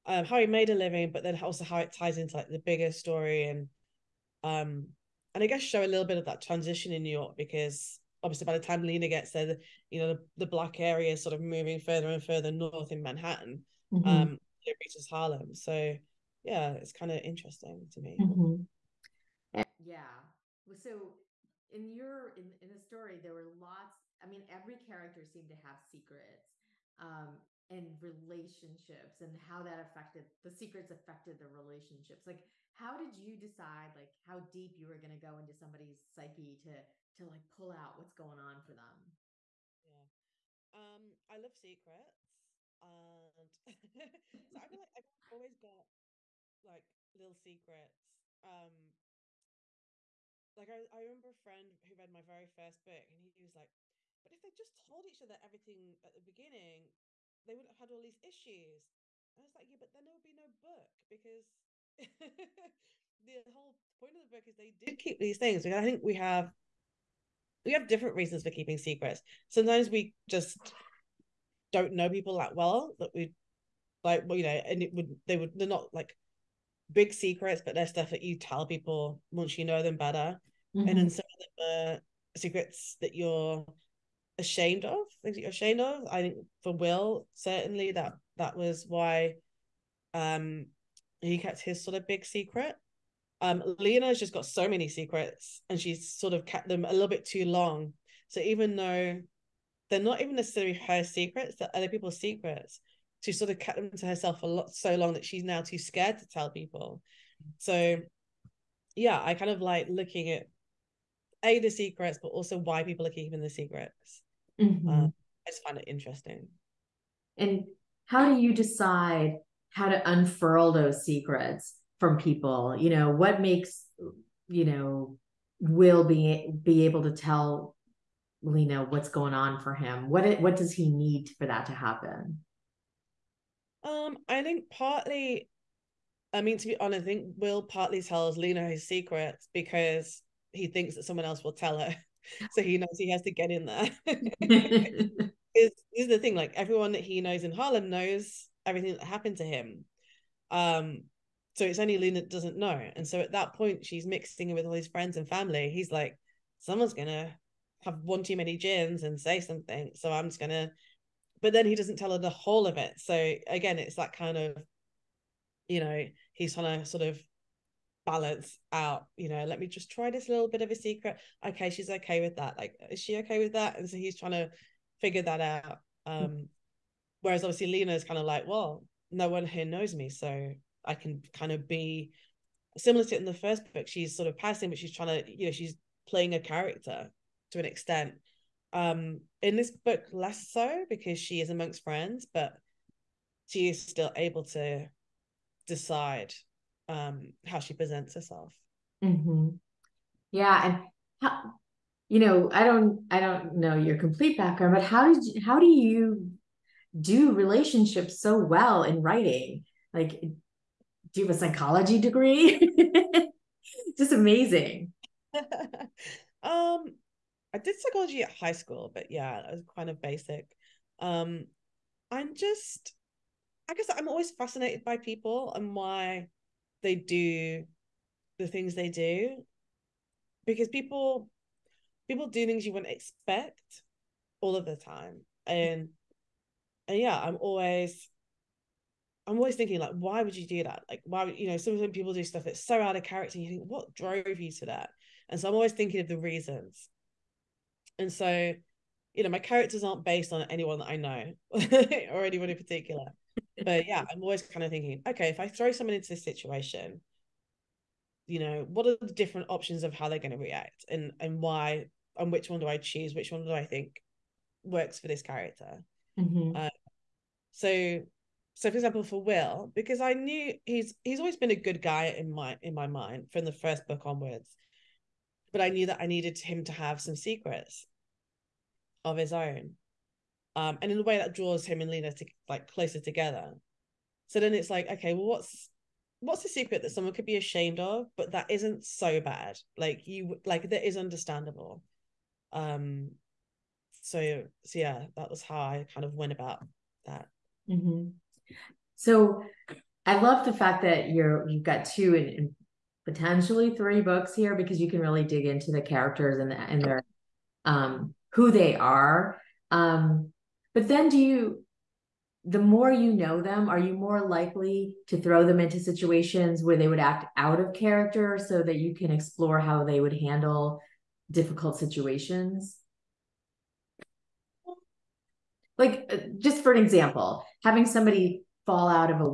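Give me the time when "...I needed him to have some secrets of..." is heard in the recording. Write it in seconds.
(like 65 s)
276 s.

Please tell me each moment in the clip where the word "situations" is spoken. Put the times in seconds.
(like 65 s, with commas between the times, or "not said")
256 s, 315 s, 321 s.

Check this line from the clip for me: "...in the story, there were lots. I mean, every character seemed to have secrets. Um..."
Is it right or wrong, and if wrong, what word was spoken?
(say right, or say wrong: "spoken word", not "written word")
right.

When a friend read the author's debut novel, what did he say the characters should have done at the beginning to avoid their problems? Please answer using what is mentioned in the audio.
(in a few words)
told each other everything.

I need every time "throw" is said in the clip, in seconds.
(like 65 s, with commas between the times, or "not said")
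255 s, 315 s.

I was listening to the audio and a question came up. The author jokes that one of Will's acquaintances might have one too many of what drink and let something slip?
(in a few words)
gins.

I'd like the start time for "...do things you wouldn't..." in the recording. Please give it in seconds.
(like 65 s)
232 s.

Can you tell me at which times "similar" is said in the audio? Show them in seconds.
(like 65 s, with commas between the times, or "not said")
182 s.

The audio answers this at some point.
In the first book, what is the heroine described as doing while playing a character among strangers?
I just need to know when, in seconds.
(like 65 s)
184 s.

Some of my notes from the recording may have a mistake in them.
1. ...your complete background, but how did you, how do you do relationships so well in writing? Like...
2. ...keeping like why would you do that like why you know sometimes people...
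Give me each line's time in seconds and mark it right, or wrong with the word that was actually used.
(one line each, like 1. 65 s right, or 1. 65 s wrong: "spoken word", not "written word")
1. 203 s right
2. 239 s wrong: "thinking", not "keeping".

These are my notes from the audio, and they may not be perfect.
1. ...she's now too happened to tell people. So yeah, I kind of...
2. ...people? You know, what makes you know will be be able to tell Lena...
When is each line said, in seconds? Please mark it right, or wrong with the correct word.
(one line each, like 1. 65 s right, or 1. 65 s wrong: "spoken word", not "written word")
1. 105 s wrong: "scared", not "happened"
2. 122 s right.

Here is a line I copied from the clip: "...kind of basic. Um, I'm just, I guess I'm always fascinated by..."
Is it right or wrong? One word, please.
right.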